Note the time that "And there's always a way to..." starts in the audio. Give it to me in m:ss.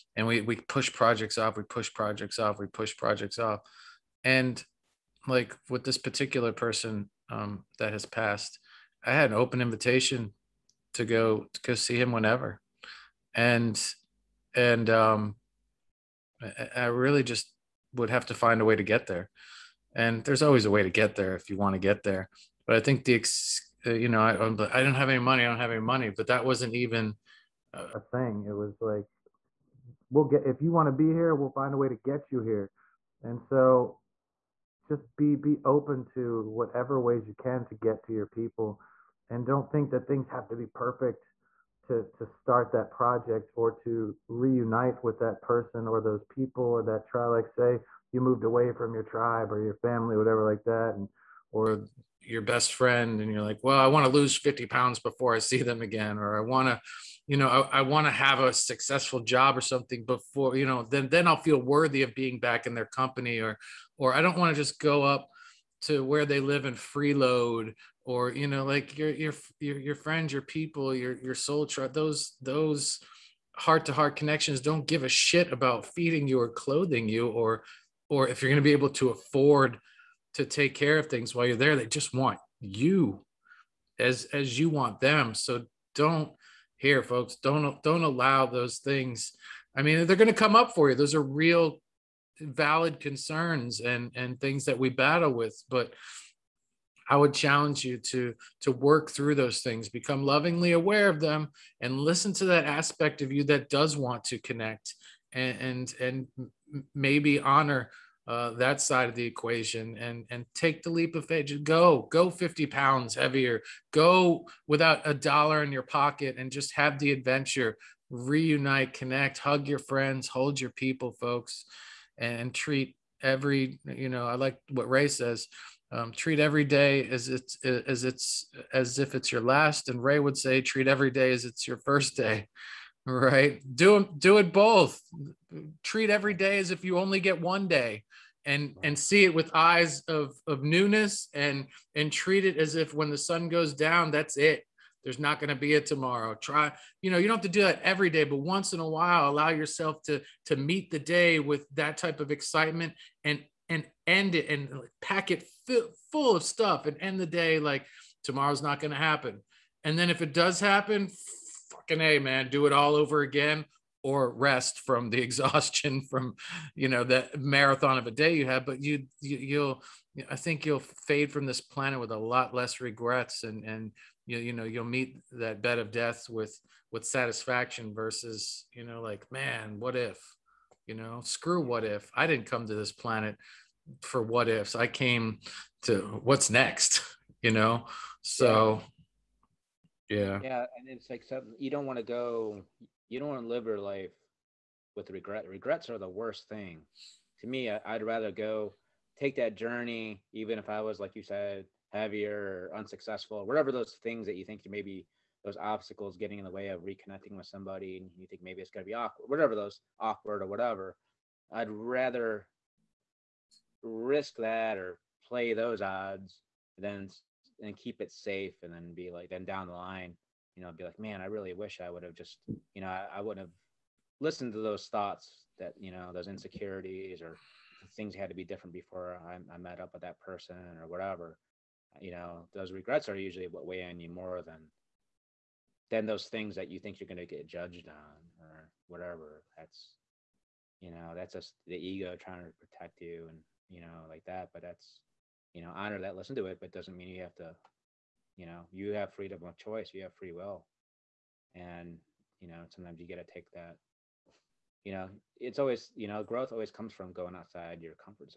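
0:19.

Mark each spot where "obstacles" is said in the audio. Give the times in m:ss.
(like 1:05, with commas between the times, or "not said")
3:25.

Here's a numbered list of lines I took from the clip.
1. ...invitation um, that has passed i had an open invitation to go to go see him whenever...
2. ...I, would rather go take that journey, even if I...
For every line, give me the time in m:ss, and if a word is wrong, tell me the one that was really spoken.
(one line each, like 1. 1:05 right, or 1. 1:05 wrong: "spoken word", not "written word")
1. 0:06 wrong: "person", not "invitation"
2. 3:17 right.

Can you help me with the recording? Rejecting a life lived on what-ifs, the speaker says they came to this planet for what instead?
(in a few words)
what's next.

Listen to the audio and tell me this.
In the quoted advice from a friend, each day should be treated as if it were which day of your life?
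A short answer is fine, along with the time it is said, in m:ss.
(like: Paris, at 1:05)
first day, at 2:11.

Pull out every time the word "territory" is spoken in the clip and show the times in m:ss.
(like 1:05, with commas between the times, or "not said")
not said.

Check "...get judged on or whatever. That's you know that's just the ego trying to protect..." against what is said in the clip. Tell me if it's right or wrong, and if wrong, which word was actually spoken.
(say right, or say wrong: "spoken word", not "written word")
right.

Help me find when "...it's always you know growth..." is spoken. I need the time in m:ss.
4:15.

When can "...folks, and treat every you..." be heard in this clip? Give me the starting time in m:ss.
2:01.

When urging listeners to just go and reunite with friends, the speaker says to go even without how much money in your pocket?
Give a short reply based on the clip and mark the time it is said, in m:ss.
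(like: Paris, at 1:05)
a dollar, at 1:55.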